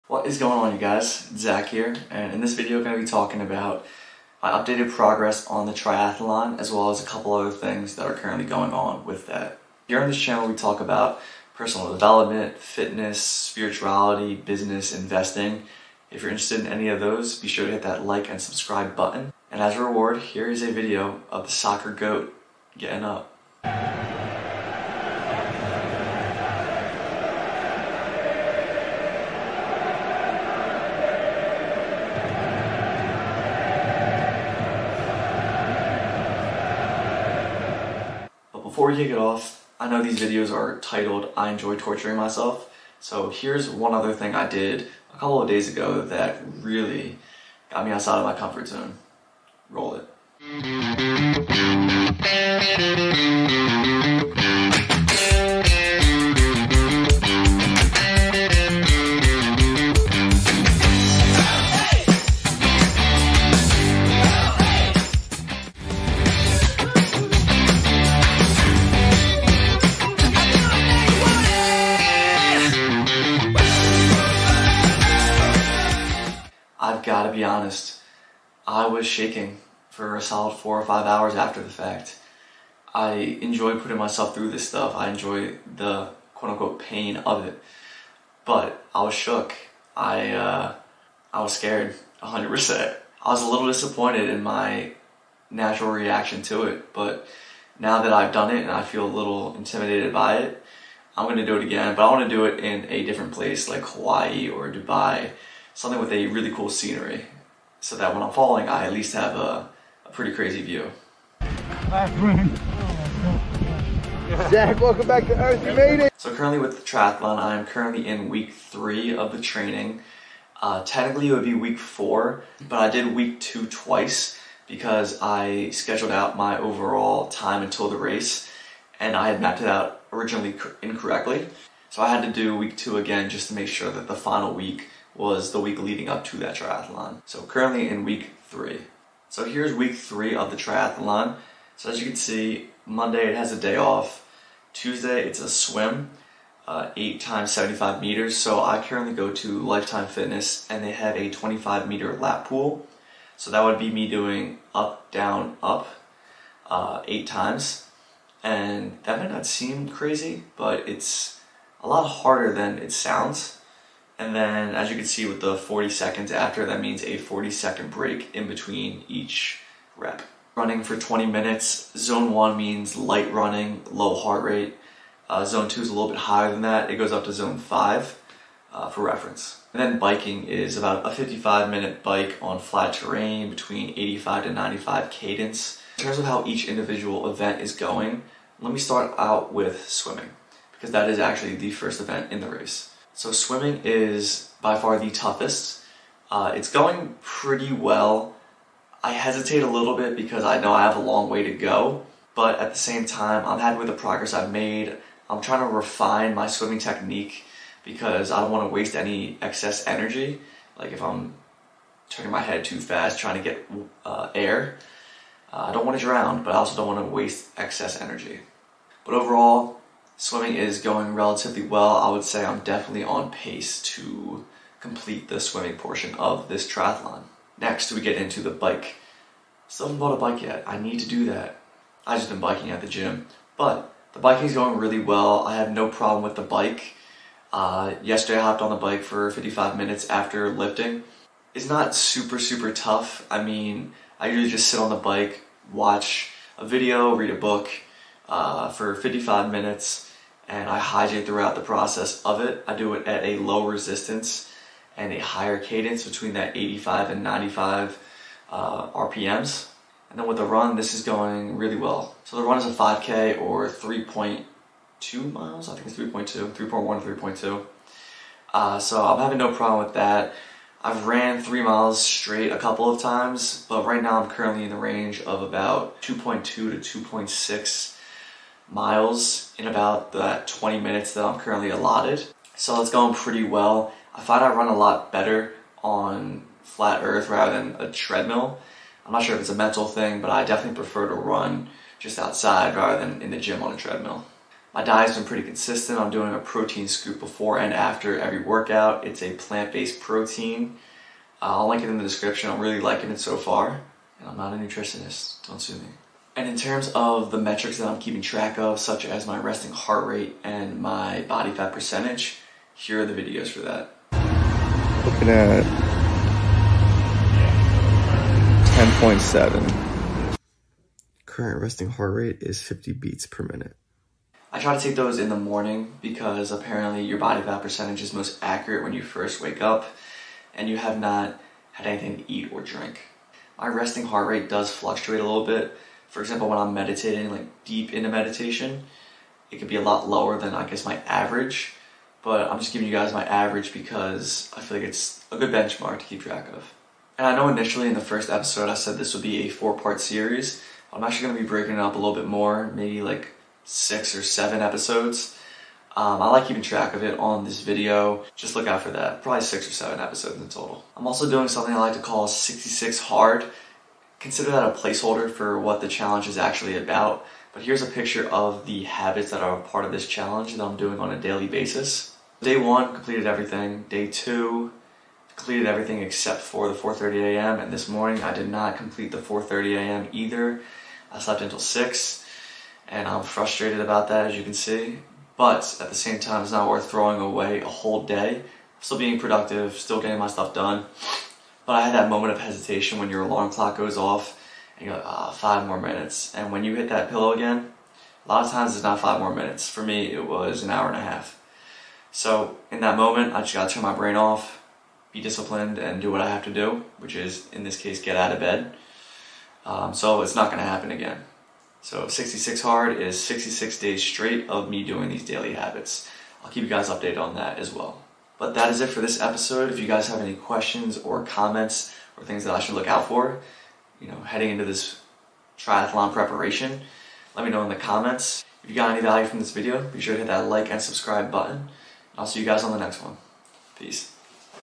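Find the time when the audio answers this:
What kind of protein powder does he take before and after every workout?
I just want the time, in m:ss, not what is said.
4:59.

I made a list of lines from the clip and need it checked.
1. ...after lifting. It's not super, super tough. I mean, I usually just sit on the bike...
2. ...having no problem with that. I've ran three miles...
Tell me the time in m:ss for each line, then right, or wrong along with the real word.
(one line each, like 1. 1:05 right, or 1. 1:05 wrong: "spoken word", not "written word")
1. 4:00 right
2. 4:29 right.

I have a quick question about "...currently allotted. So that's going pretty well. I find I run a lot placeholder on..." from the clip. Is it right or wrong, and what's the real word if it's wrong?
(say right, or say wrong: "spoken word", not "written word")
wrong: "better", not "placeholder".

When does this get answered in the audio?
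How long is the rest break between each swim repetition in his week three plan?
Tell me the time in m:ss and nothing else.
2:47.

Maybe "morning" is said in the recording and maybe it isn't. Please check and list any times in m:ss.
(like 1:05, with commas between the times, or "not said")
5:25, 6:17.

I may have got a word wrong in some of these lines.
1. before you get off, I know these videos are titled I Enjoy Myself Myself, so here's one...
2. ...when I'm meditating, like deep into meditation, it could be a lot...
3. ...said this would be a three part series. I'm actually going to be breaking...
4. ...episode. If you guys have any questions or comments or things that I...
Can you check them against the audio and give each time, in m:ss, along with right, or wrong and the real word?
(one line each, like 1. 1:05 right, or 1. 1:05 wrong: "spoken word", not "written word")
1. 0:38 wrong: "Torturing", not "Myself"
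2. 5:36 right
3. 5:48 wrong: "four", not "three"
4. 6:59 right.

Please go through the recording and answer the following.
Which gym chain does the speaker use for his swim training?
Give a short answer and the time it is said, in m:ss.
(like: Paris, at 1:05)
Lifetime Fitness, at 2:29.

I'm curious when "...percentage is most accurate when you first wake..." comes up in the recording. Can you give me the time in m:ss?
5:27.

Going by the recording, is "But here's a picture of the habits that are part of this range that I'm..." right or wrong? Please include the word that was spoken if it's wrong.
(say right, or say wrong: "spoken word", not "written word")
wrong: "challenge", not "range".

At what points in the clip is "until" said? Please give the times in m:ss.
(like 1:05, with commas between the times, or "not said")
2:07, 6:21.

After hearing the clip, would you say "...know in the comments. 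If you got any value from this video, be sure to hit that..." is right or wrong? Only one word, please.
right.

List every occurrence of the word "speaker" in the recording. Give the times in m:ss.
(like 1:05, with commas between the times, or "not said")
not said.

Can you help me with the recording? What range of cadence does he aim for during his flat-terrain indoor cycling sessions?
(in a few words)
85 to 95.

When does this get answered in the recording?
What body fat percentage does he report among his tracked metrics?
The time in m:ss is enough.
5:18.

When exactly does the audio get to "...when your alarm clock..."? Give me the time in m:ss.
6:32.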